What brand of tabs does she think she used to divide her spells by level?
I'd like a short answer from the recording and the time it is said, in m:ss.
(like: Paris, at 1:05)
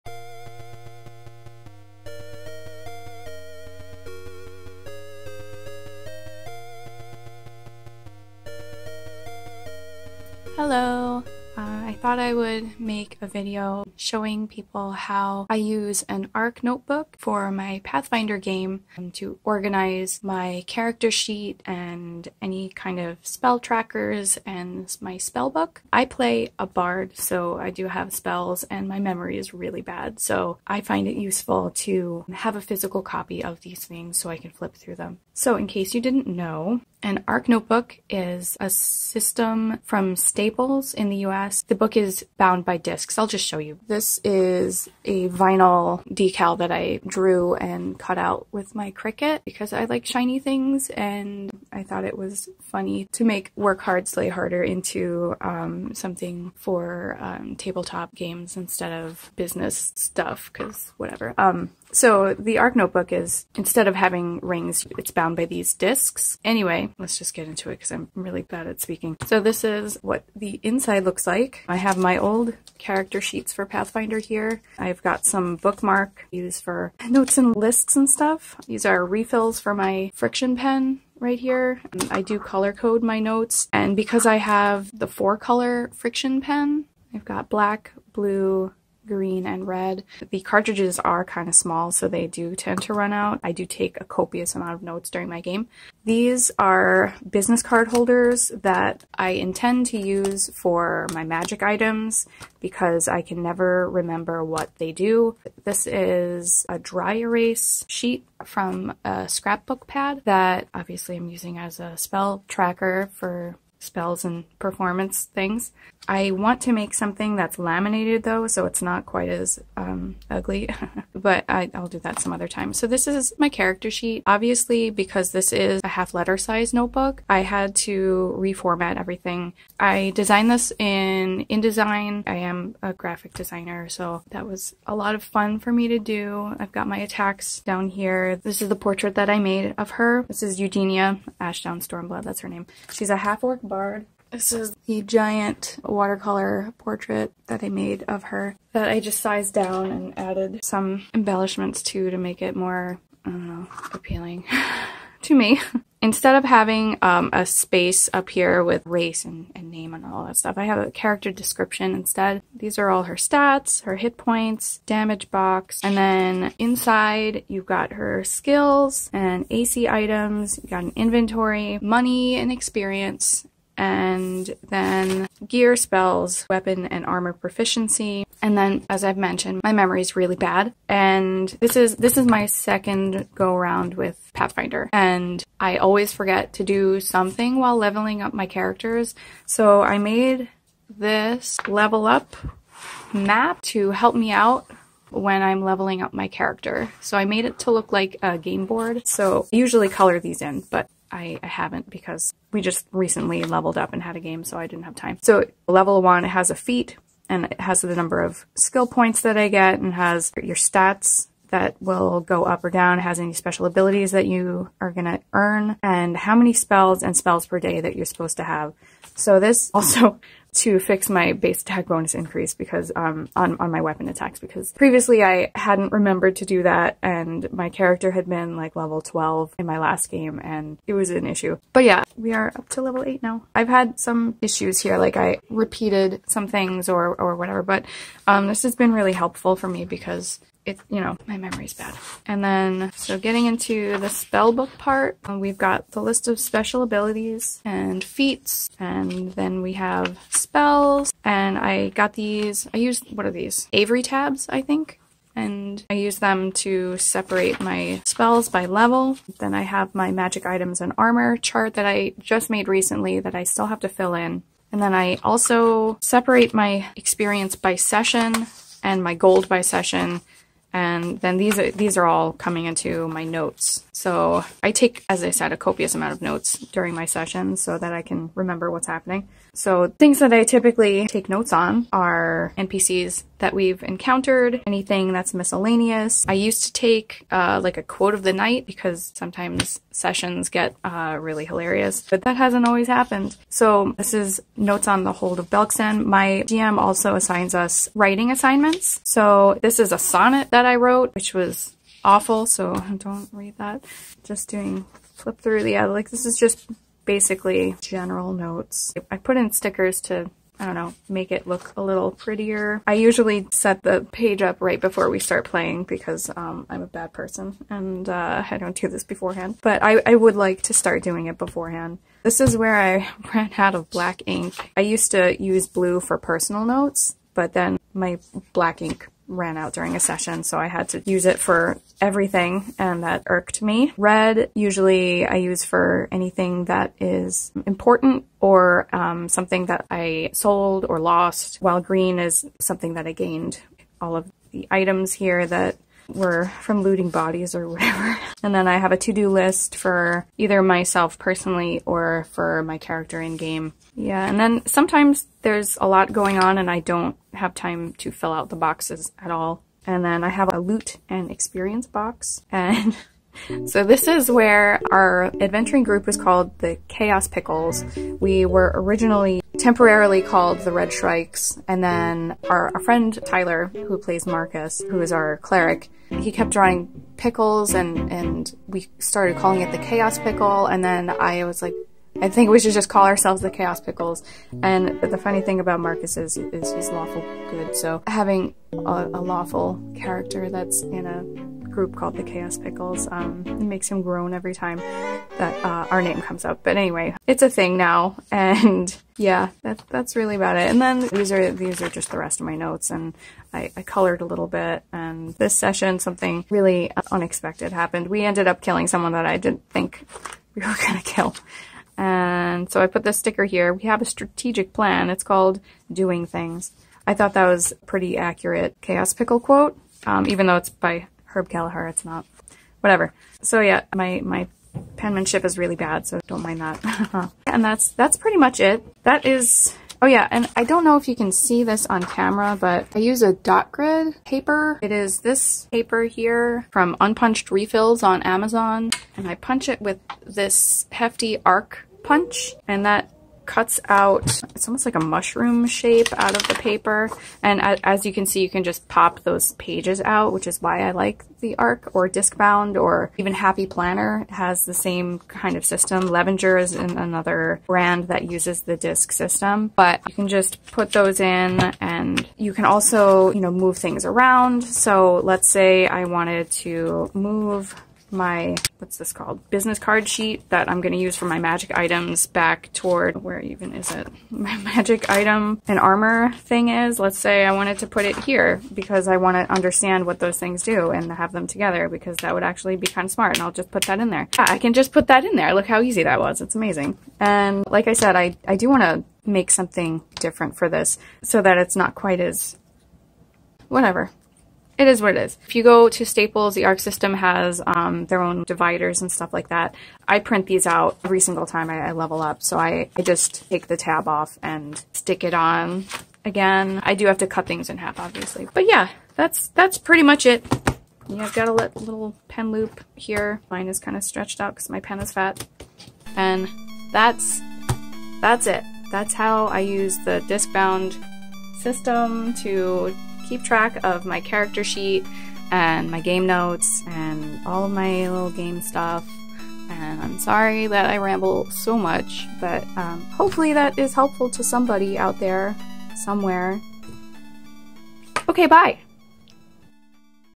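Avery, at 4:13.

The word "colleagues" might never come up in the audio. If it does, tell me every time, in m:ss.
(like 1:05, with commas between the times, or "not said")
not said.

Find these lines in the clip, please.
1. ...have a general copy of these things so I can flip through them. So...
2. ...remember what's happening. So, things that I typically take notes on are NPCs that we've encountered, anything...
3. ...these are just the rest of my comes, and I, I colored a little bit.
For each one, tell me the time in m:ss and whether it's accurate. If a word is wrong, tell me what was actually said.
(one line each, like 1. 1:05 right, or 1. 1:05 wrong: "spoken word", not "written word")
1. 0:32 wrong: "physical", not "general"
2. 4:38 right
3. 6:41 wrong: "notes", not "comes".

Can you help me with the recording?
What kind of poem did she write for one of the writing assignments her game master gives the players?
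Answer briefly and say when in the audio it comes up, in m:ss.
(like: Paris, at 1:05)
A sonnet, at 4:59.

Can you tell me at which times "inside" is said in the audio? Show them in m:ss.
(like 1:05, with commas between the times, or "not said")
1:10, 2:46.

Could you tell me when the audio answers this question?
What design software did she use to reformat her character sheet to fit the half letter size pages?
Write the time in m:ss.
2:11.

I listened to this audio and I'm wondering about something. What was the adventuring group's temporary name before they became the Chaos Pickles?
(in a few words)
Red Shrikes.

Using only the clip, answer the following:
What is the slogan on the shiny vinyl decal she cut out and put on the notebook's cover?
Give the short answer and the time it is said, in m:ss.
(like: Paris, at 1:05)
Work Hard, Slay Harder, at 0:53.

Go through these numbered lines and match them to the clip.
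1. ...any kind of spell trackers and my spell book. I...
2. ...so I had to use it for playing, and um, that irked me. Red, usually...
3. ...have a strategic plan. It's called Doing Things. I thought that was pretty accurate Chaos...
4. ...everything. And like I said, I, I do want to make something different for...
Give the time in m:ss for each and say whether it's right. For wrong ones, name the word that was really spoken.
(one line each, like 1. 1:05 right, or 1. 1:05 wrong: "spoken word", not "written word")
1. 0:22 right
2. 5:30 wrong: "everything", not "playing"
3. 6:53 right
4. 8:06 wrong: "amazing", not "everything".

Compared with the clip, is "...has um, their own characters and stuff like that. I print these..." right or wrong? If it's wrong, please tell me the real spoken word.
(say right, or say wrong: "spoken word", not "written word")
wrong: "dividers", not "characters".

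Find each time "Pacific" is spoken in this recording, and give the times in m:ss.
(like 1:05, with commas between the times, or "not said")
not said.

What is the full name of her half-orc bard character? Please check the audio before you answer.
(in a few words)
Eugenia Ashdown Stormblood.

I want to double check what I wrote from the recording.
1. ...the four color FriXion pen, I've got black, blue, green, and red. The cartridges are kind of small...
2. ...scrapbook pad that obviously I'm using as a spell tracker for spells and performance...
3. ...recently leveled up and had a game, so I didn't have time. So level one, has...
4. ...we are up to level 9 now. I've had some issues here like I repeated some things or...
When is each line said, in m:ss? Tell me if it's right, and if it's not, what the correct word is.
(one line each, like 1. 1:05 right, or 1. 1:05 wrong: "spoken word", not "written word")
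1. 1:24 right
2. 1:49 right
3. 3:22 right
4. 3:52 wrong: "8", not "9".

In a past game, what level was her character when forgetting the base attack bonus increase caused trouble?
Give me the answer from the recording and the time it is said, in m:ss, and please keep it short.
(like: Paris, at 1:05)
12, at 3:48.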